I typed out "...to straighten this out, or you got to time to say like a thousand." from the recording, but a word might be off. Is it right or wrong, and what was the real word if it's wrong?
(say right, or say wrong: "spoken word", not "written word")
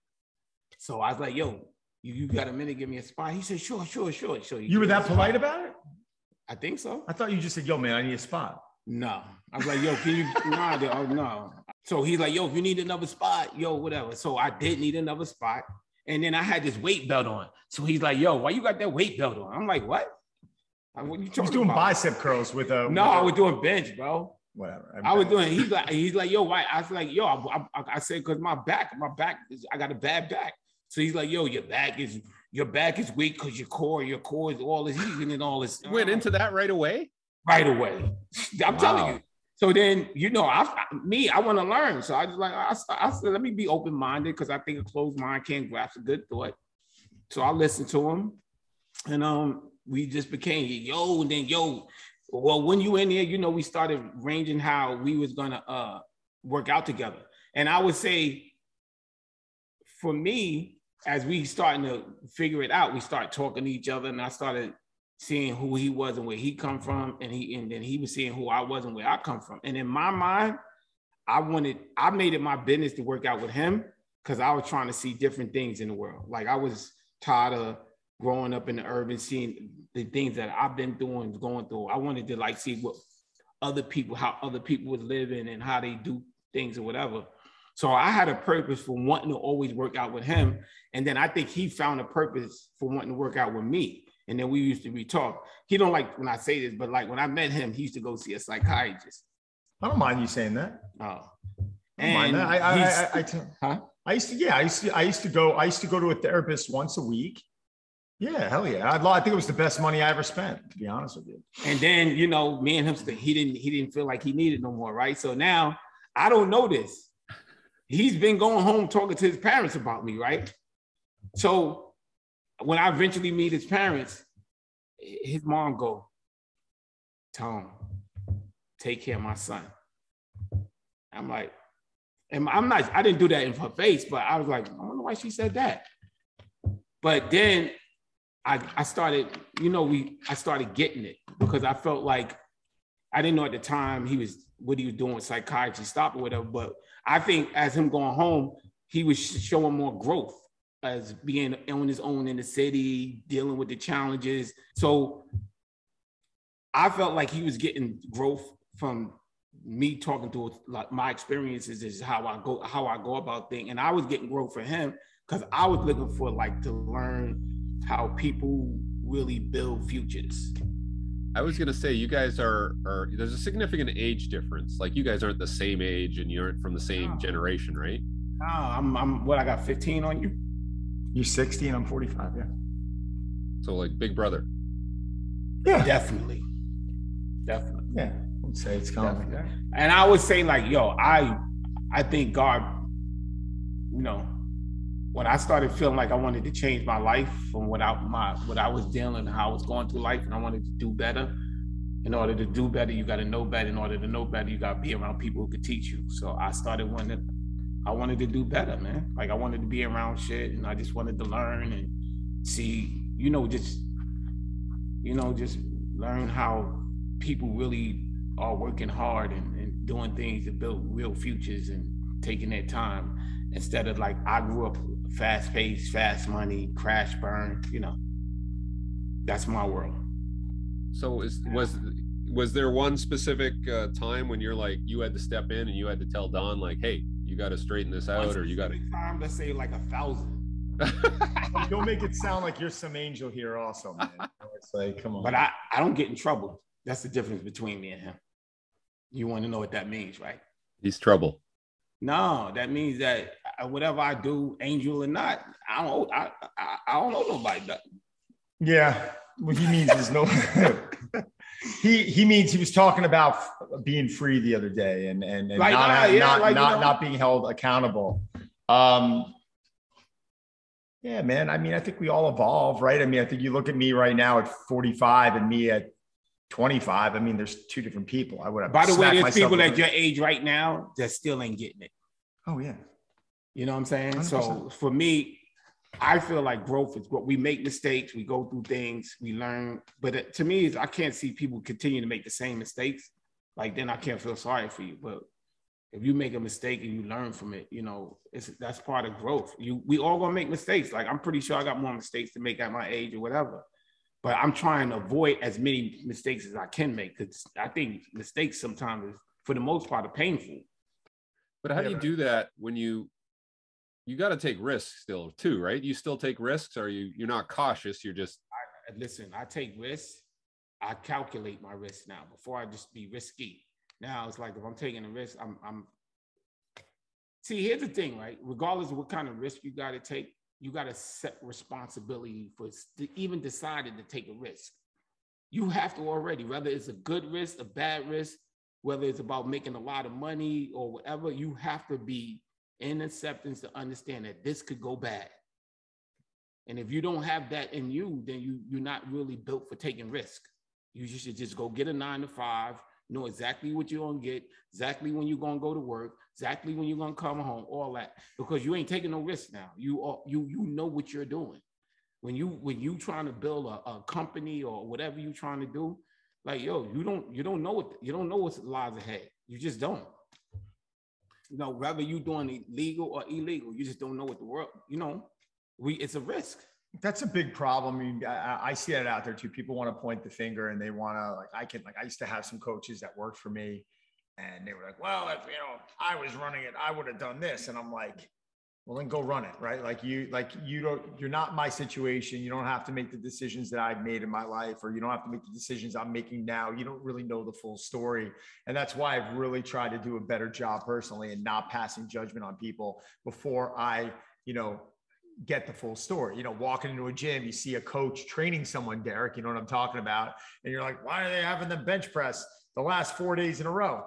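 right.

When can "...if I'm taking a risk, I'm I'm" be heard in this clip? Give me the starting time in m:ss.
5:24.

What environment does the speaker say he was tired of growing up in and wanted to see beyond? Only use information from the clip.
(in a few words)
The urban.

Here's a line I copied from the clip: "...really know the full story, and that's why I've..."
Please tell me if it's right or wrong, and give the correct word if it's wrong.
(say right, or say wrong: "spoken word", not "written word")
right.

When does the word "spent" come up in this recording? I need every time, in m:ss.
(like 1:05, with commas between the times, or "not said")
1:50.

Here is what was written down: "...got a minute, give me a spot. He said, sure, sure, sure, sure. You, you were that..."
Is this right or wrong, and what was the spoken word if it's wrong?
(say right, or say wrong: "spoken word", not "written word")
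right.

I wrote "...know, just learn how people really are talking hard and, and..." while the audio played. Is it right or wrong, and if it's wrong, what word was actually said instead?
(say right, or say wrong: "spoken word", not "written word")
wrong: "working", not "talking".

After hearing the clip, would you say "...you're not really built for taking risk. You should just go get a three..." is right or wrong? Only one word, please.
wrong.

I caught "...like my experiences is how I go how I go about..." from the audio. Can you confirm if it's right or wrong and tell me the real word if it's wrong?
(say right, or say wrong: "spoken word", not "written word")
right.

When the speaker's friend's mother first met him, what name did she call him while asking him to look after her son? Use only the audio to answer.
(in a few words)
Tone.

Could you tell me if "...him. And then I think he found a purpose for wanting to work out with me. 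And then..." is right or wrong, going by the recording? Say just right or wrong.
right.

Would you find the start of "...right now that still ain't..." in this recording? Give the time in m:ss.
4:40.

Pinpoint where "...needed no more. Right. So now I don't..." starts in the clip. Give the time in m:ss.
1:54.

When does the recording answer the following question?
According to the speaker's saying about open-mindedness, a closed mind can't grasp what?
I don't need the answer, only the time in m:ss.
0:45.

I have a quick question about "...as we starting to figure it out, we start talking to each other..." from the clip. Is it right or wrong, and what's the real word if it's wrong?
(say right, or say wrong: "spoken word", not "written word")
right.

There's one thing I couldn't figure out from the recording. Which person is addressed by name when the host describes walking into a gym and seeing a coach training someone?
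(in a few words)
Derek.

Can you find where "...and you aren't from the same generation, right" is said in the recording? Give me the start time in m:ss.
2:56.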